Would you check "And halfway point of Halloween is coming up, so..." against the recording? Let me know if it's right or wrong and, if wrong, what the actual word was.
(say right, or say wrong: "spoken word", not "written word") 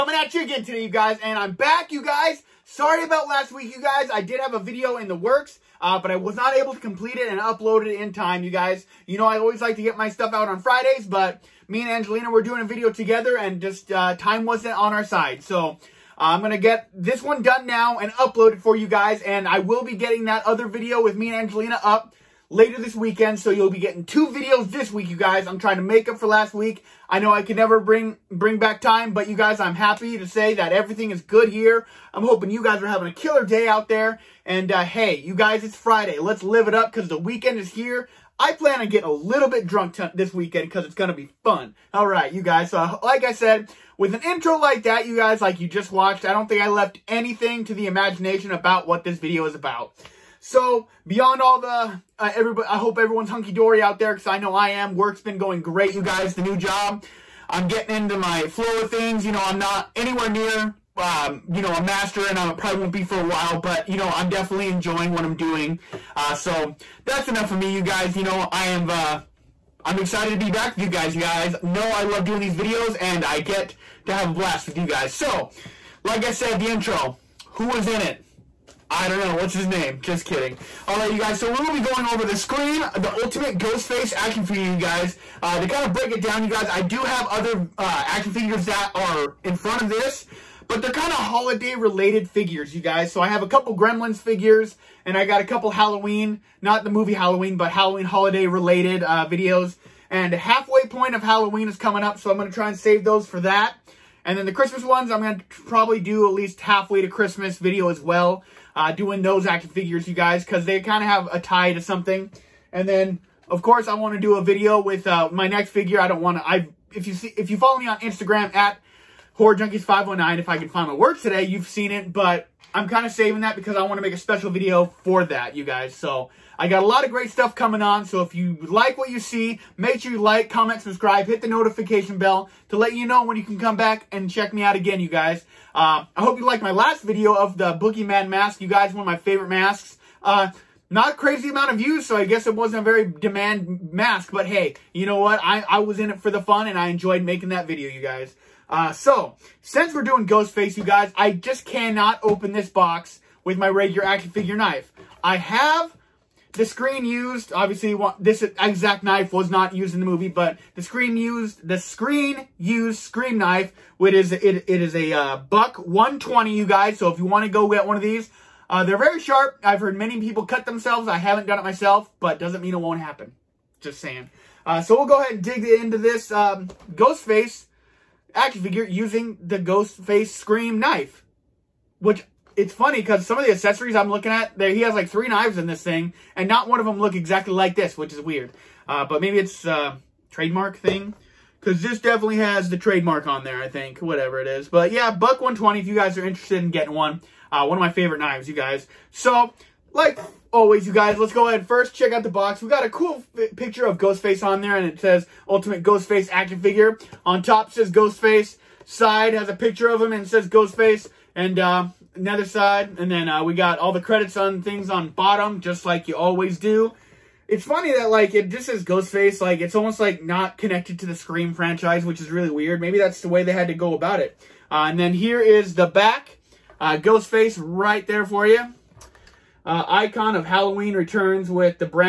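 right.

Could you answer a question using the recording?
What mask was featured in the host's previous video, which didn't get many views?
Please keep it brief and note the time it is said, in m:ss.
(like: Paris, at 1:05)
Boogeyman mask, at 2:17.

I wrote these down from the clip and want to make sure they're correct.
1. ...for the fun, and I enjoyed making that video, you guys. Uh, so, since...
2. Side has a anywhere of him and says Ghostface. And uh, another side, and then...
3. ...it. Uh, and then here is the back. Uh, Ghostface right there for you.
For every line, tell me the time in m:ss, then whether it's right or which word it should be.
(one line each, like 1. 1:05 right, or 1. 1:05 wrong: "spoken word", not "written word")
1. 2:26 right
2. 3:28 wrong: "picture", not "anywhere"
3. 3:44 right.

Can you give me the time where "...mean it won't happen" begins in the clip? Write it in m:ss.
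2:52.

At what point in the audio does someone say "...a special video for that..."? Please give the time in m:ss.
2:04.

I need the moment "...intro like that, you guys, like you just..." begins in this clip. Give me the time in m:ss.
0:44.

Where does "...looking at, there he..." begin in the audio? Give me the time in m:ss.
3:04.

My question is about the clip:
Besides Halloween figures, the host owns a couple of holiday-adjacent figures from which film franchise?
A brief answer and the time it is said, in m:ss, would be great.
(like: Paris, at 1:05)
Gremlins, at 1:33.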